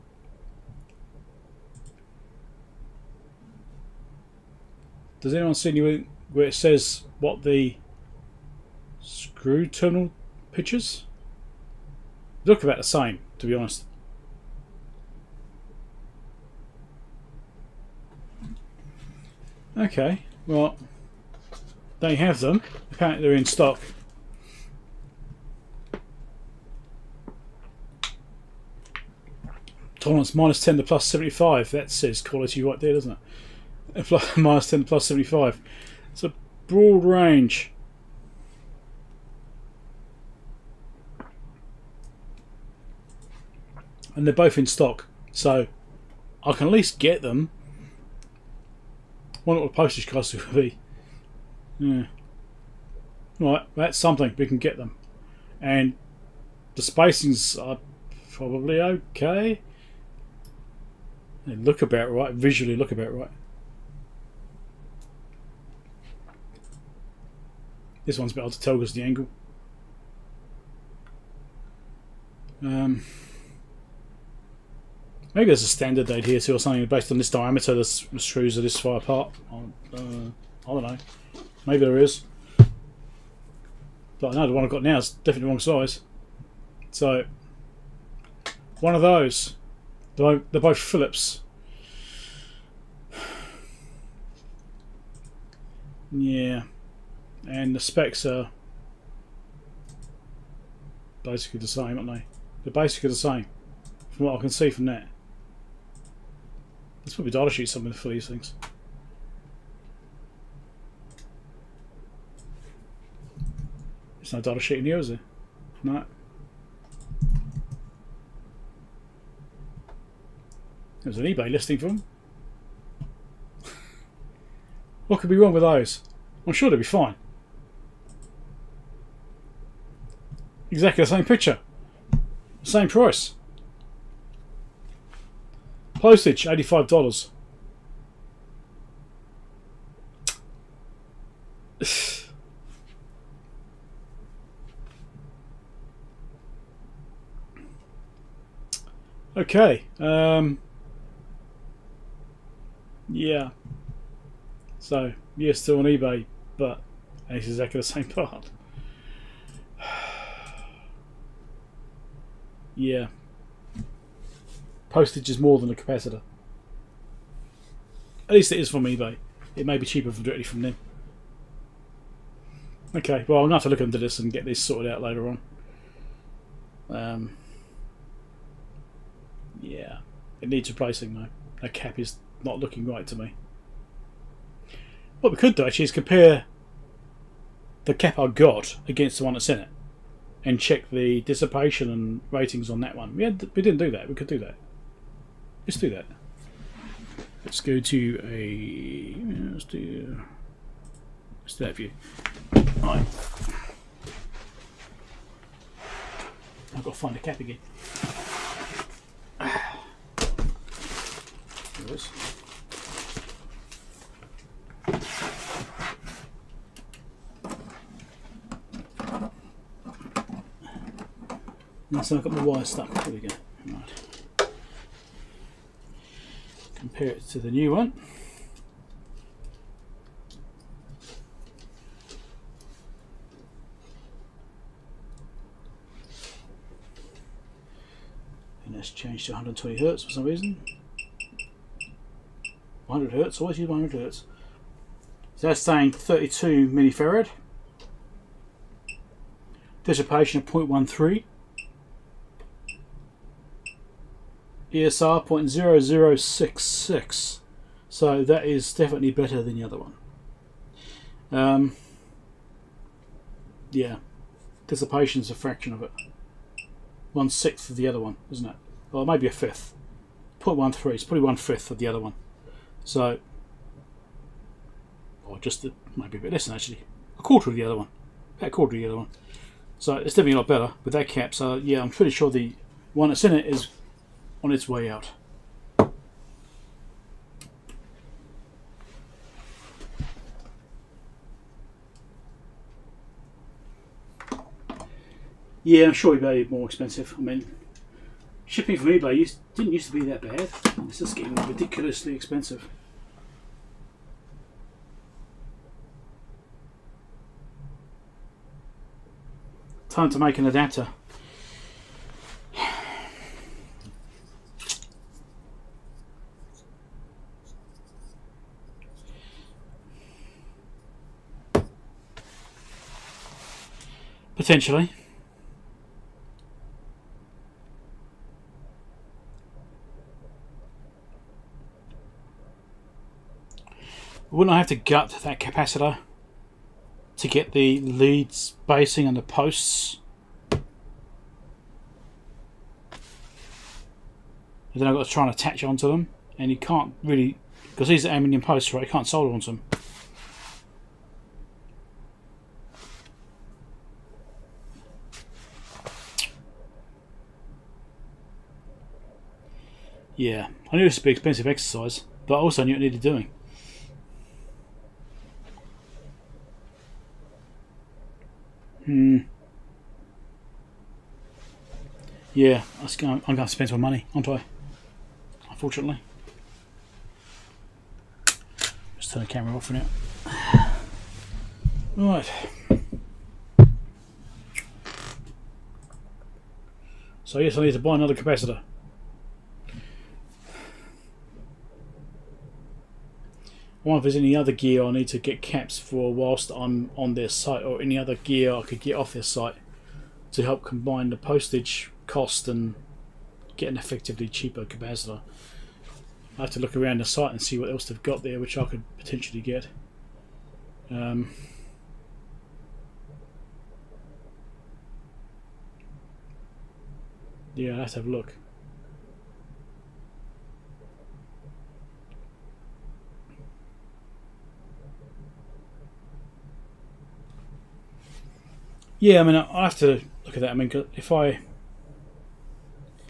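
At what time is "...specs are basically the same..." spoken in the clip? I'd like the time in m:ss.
1:37.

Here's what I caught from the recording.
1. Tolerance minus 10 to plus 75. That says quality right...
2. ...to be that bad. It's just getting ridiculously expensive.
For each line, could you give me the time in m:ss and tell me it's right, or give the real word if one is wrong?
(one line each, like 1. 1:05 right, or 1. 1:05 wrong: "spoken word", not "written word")
1. 0:29 right
2. 4:59 right.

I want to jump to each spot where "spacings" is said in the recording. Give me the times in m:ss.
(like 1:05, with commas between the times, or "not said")
0:56, 5:38.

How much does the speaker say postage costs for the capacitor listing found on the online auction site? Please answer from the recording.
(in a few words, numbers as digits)
$85.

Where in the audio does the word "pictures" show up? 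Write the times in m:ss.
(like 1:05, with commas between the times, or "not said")
0:10, 2:11.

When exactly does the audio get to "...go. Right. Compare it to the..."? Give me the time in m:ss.
3:43.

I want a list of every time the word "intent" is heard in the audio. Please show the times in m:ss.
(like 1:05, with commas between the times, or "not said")
not said.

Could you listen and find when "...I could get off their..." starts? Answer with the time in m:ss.
6:38.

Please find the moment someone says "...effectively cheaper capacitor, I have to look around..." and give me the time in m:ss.
6:43.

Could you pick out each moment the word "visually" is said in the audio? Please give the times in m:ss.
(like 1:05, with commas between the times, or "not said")
1:02.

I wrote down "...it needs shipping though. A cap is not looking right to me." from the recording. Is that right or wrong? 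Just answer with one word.
wrong.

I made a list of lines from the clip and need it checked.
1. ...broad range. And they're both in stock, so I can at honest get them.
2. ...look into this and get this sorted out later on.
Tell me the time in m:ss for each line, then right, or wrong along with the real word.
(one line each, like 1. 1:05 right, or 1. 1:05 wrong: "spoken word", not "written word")
1. 0:36 wrong: "least", not "honest"
2. 2:53 right.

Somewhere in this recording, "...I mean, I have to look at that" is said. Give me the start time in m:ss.
7:09.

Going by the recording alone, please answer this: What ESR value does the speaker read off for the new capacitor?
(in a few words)
0.0066.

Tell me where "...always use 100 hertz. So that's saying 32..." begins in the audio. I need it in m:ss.
4:03.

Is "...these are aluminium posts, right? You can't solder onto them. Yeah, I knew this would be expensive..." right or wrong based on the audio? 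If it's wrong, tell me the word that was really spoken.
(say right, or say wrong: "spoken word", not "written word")
right.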